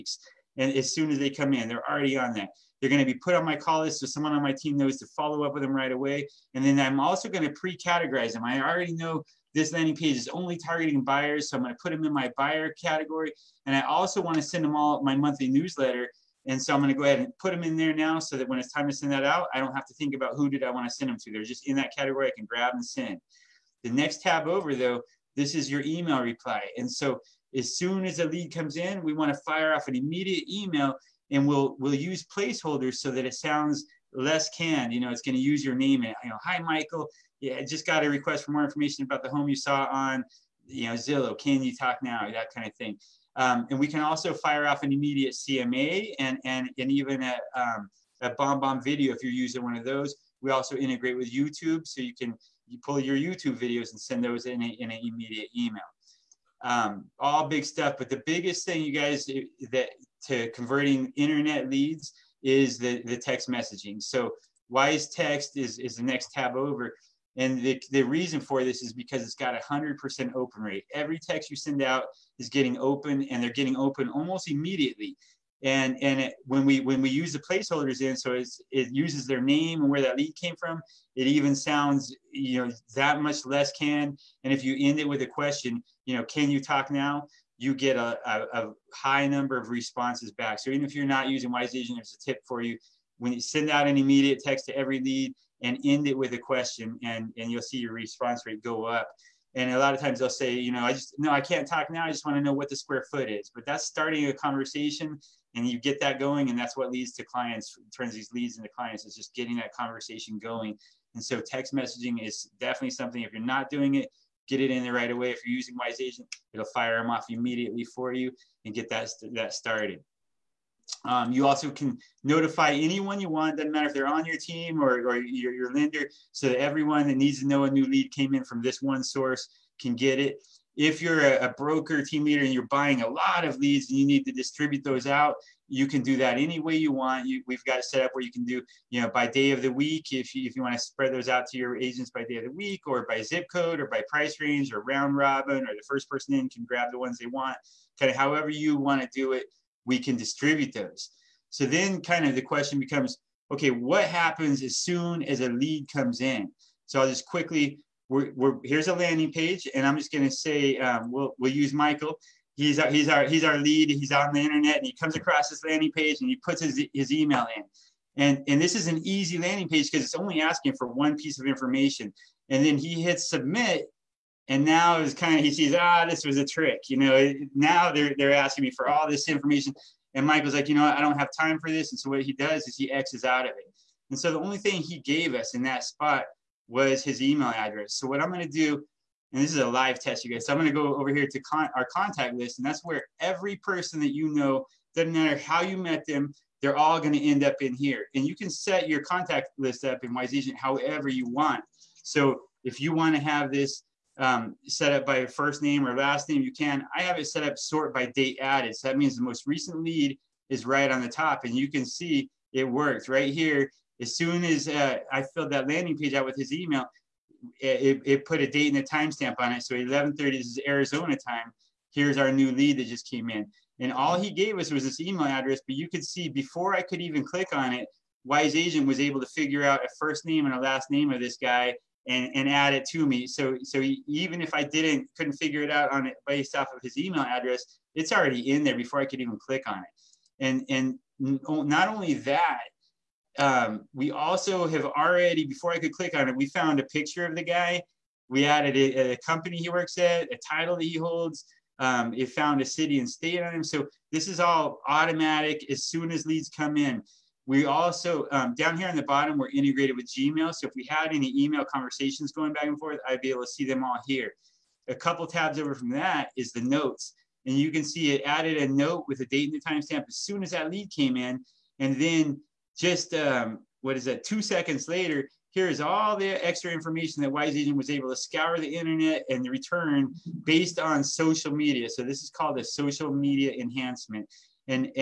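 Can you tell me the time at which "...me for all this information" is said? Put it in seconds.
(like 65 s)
178 s.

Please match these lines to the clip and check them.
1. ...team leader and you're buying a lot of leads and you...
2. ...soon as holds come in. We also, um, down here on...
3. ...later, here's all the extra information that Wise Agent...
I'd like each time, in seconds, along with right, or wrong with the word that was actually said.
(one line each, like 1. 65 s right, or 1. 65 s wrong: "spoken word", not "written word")
1. 132 s right
2. 255 s wrong: "leads", not "holds"
3. 274 s right.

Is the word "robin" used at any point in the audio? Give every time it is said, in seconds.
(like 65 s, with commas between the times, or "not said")
145 s.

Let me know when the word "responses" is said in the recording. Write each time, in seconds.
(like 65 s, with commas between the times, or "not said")
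89 s, 97 s.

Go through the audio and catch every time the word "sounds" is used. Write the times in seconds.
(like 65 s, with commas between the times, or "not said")
33 s, 81 s.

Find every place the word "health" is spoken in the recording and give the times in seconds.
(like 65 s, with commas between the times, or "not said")
not said.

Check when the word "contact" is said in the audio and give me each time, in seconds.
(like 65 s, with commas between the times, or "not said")
191 s, 199 s.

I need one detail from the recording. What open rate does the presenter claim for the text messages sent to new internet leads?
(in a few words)
100%.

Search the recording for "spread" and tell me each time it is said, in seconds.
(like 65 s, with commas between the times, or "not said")
140 s.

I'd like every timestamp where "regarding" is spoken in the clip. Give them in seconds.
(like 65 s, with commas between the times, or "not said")
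not said.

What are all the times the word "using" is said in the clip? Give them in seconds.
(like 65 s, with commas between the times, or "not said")
49 s, 91 s, 115 s.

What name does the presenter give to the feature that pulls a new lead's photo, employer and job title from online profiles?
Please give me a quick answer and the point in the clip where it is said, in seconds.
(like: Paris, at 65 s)
social media enhancement, at 282 s.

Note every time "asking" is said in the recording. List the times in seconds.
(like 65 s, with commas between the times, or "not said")
170 s, 178 s.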